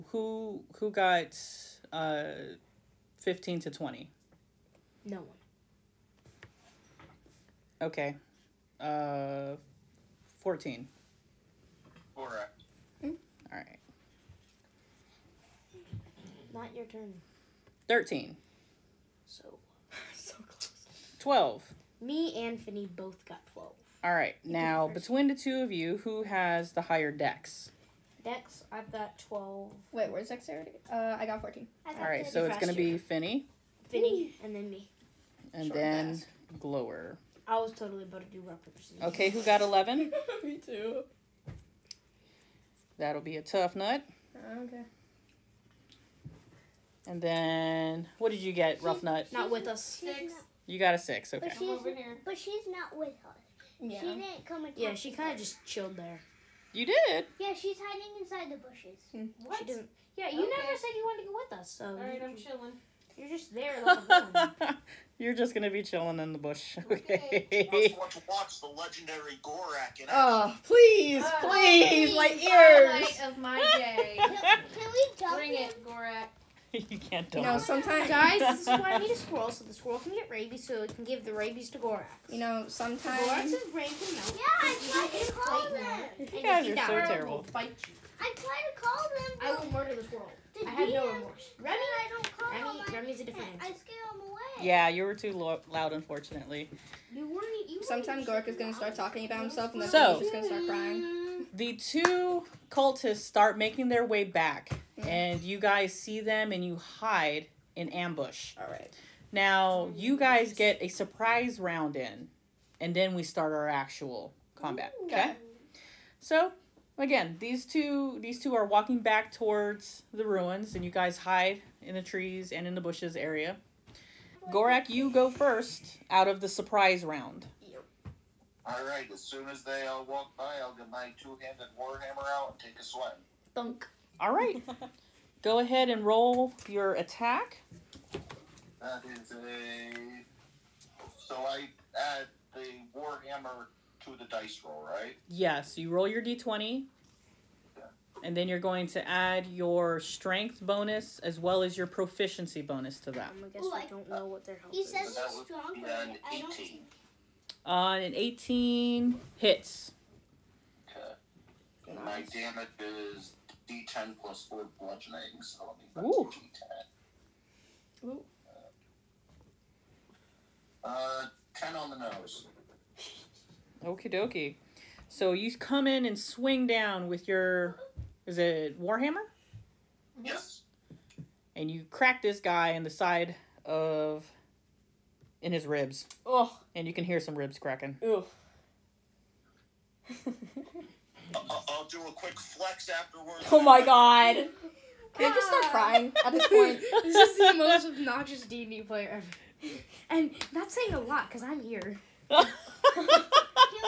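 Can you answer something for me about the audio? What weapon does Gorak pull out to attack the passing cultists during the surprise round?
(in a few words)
two-handed warhammer.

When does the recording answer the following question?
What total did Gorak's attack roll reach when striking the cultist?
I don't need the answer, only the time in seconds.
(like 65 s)
158 s.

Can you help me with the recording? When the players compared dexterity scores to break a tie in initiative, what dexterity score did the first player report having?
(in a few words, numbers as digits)
12.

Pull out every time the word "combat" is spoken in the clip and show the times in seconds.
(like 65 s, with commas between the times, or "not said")
114 s.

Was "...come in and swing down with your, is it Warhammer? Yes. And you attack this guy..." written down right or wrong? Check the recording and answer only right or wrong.
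wrong.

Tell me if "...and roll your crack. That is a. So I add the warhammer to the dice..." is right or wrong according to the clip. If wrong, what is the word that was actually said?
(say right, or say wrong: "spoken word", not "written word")
wrong: "attack", not "crack".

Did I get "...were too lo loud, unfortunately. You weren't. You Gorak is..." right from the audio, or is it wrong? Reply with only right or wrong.
right.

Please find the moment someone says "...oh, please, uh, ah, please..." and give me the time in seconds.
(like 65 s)
70 s.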